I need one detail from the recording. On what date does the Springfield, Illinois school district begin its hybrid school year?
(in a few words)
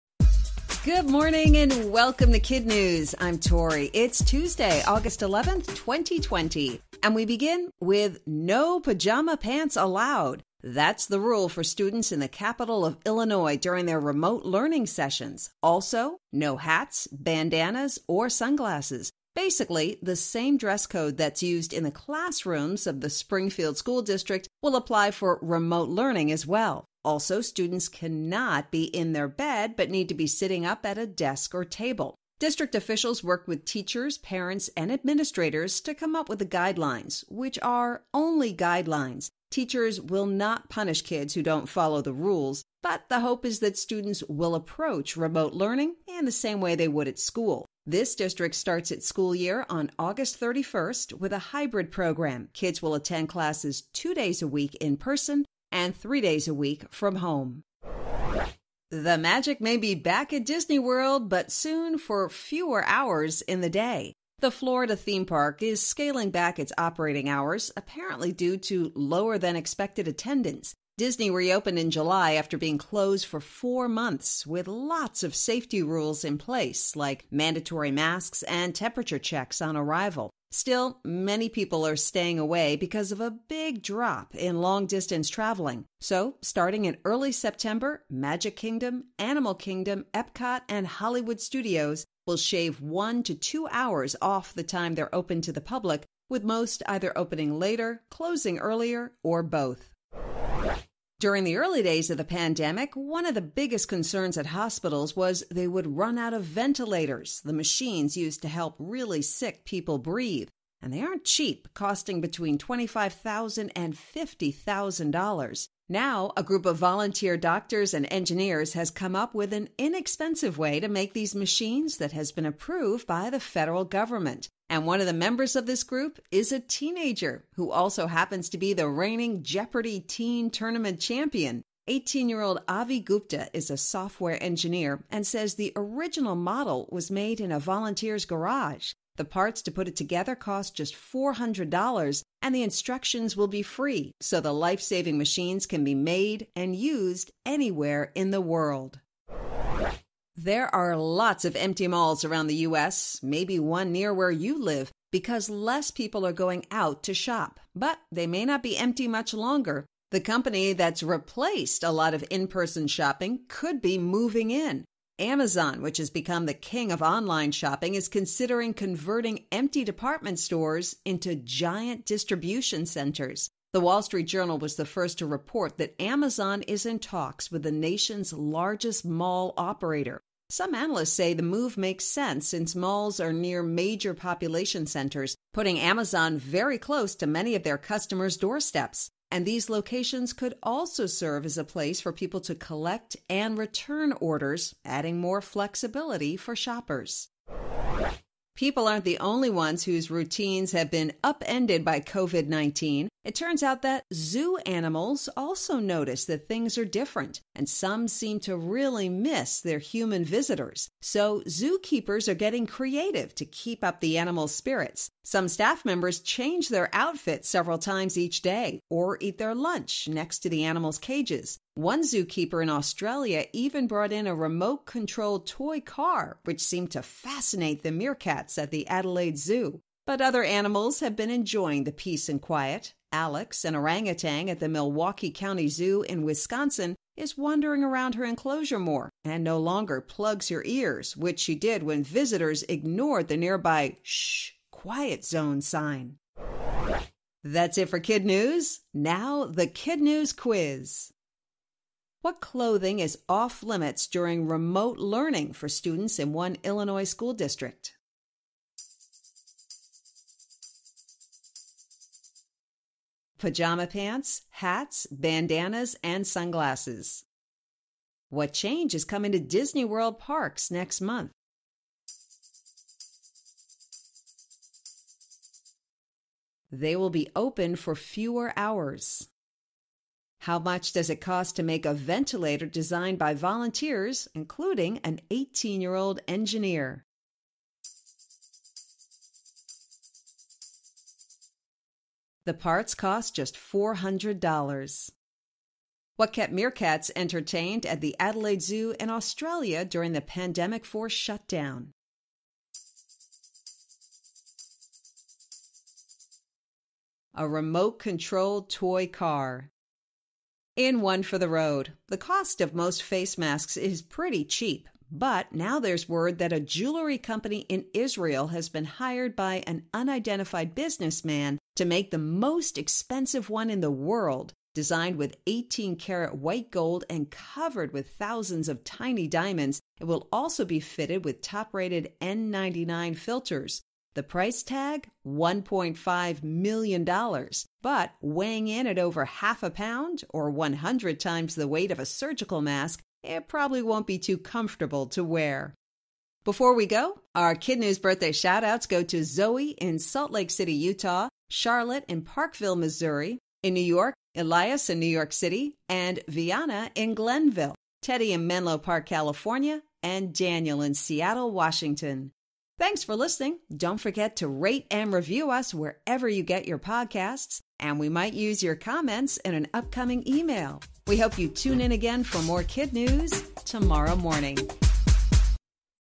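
August 31st.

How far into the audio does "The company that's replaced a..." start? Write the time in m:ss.
2:40.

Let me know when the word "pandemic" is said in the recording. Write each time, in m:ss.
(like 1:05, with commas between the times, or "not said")
1:42, 5:00.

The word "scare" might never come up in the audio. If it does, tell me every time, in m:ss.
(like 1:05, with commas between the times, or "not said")
not said.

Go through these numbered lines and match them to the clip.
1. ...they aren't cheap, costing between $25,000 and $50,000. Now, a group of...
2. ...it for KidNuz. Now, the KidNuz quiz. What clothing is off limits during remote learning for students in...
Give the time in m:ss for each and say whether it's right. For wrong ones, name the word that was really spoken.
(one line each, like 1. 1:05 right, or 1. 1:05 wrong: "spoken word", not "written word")
1. 1:50 right
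2. 4:07 right.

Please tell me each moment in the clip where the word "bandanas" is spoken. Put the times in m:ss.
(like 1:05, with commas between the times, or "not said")
0:17, 4:25.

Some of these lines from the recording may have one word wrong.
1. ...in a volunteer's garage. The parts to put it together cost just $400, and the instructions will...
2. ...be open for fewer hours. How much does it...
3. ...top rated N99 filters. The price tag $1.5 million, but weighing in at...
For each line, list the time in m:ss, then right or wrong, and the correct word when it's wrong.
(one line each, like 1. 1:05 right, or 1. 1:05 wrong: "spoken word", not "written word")
1. 2:17 right
2. 4:37 right
3. 5:31 right.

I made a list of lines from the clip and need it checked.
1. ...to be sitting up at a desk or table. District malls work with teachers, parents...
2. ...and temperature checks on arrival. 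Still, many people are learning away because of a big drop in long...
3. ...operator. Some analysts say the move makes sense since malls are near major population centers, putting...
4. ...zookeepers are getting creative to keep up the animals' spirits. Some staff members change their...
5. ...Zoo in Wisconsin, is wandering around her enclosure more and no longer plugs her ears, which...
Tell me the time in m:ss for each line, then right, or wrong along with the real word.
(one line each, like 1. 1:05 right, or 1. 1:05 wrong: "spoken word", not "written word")
1. 0:30 wrong: "officials", not "malls"
2. 1:18 wrong: "staying", not "learning"
3. 2:59 right
4. 3:31 right
5. 3:55 right.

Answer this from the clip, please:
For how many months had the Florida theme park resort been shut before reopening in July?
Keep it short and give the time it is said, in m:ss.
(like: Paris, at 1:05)
4 months, at 1:13.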